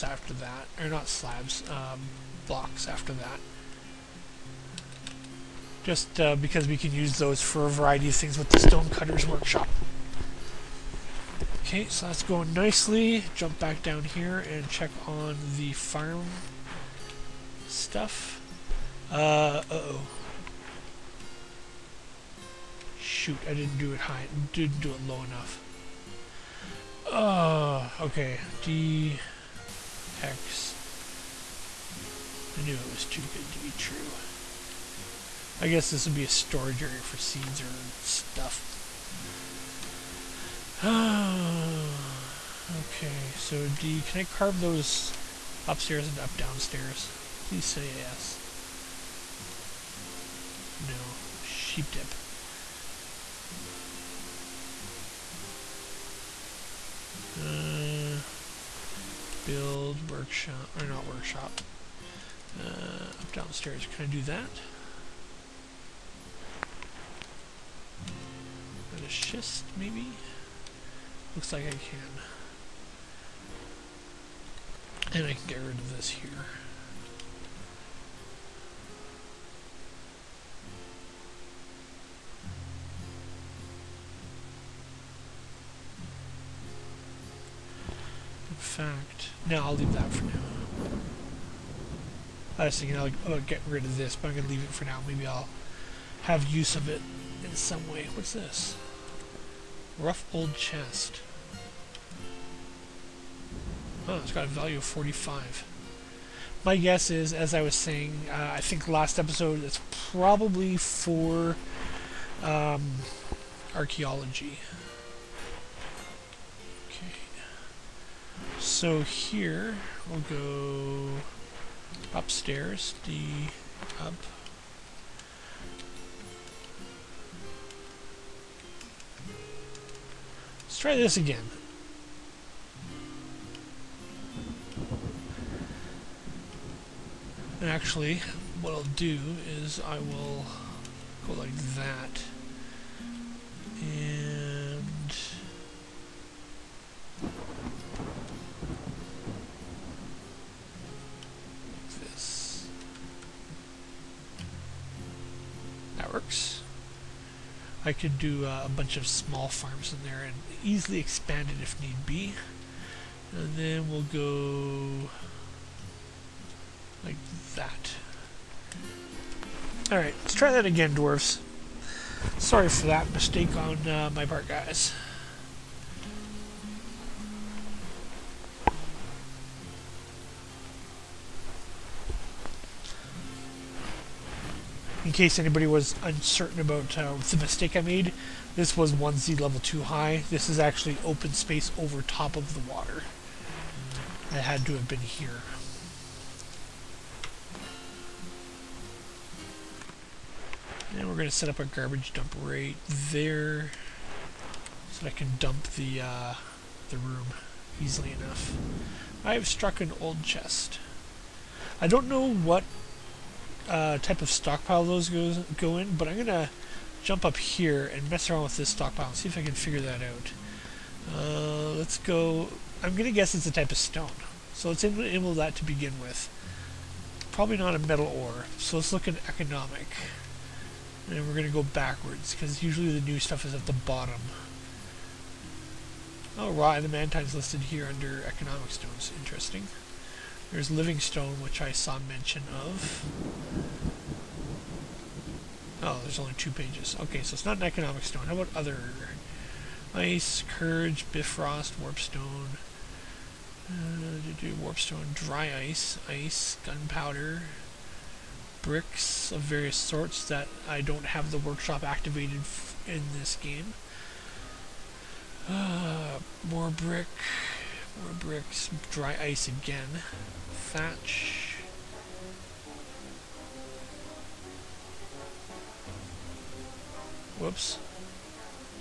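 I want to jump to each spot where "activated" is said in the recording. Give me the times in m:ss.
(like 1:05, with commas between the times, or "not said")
4:21.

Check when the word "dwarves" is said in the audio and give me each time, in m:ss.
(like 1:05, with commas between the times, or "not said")
2:50.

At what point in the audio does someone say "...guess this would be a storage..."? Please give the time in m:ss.
0:35.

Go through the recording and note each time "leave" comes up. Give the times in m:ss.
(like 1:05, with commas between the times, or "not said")
1:29, 1:34.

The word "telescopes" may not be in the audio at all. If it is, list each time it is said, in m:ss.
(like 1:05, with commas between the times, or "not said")
not said.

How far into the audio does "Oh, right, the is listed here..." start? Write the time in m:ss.
3:56.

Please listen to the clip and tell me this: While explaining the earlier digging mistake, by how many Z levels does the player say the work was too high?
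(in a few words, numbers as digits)
1.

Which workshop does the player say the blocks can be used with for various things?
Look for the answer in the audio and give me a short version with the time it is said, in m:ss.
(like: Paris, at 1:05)
Stonecutters Workshop, at 0:08.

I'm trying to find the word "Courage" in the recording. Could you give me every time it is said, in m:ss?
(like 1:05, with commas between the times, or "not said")
4:10.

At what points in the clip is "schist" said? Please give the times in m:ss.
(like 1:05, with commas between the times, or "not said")
1:09.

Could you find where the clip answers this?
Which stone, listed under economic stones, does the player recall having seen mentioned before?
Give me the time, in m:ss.
4:00.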